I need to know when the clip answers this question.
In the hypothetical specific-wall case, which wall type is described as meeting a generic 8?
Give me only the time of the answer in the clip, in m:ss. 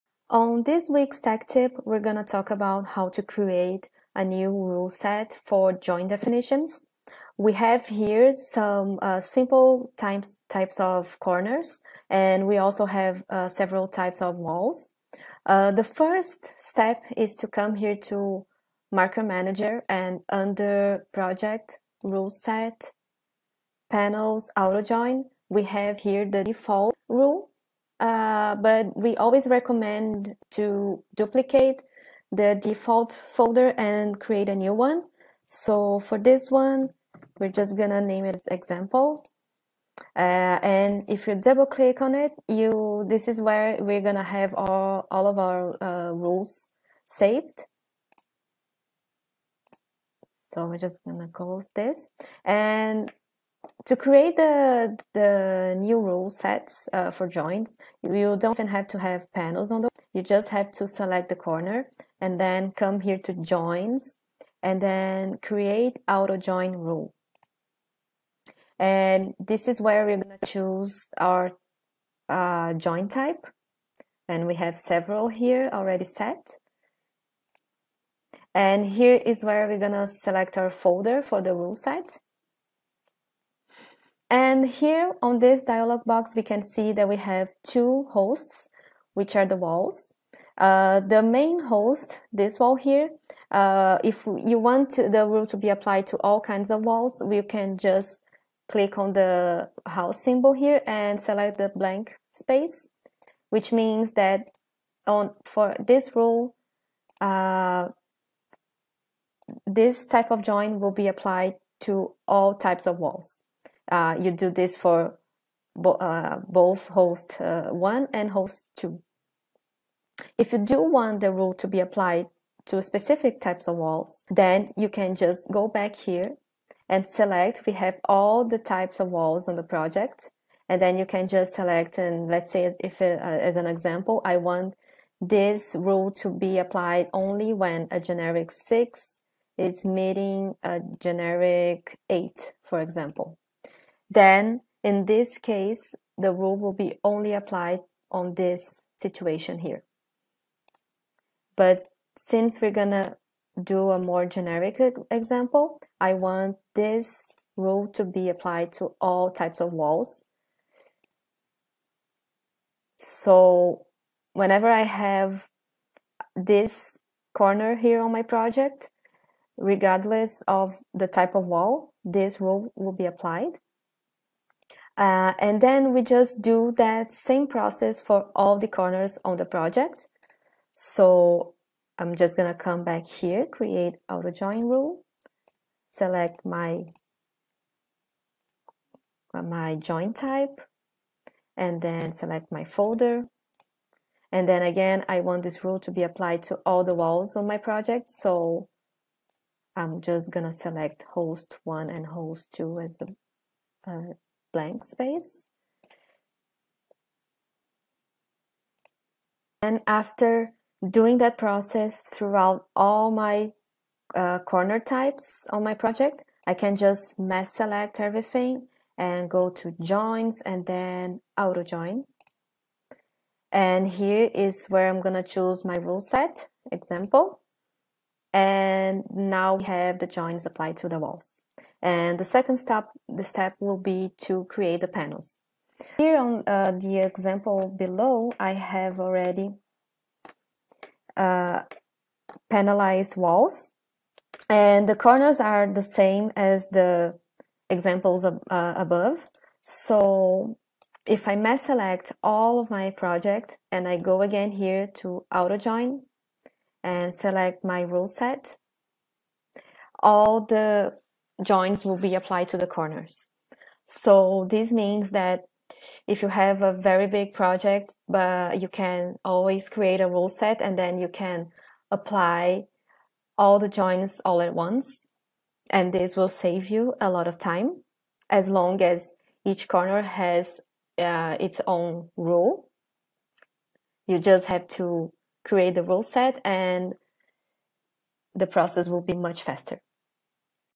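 2:17.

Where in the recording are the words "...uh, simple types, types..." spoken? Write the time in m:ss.
0:09.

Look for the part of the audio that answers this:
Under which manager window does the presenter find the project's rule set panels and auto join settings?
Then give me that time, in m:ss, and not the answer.
0:18.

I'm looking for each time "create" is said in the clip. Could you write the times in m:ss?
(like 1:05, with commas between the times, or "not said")
0:03, 0:34, 0:53, 1:05, 3:03, 3:54, 4:29, 4:45.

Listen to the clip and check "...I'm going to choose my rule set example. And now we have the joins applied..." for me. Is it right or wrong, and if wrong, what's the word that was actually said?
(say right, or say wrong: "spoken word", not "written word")
right.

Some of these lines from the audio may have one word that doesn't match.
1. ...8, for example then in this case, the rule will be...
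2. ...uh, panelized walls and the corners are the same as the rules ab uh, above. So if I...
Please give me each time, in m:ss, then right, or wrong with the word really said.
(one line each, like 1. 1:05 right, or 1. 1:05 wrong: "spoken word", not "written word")
1. 2:22 right
2. 4:01 wrong: "examples", not "rules".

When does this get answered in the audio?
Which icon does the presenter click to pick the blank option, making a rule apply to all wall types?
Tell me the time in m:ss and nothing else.
1:39.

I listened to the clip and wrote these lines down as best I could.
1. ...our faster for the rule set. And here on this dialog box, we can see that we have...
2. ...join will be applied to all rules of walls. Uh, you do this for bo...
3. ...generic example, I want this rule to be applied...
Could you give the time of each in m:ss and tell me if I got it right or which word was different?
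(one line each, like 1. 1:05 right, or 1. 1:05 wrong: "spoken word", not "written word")
1. 1:20 wrong: "folder", not "faster"
2. 1:50 wrong: "types", not "rules"
3. 2:34 right.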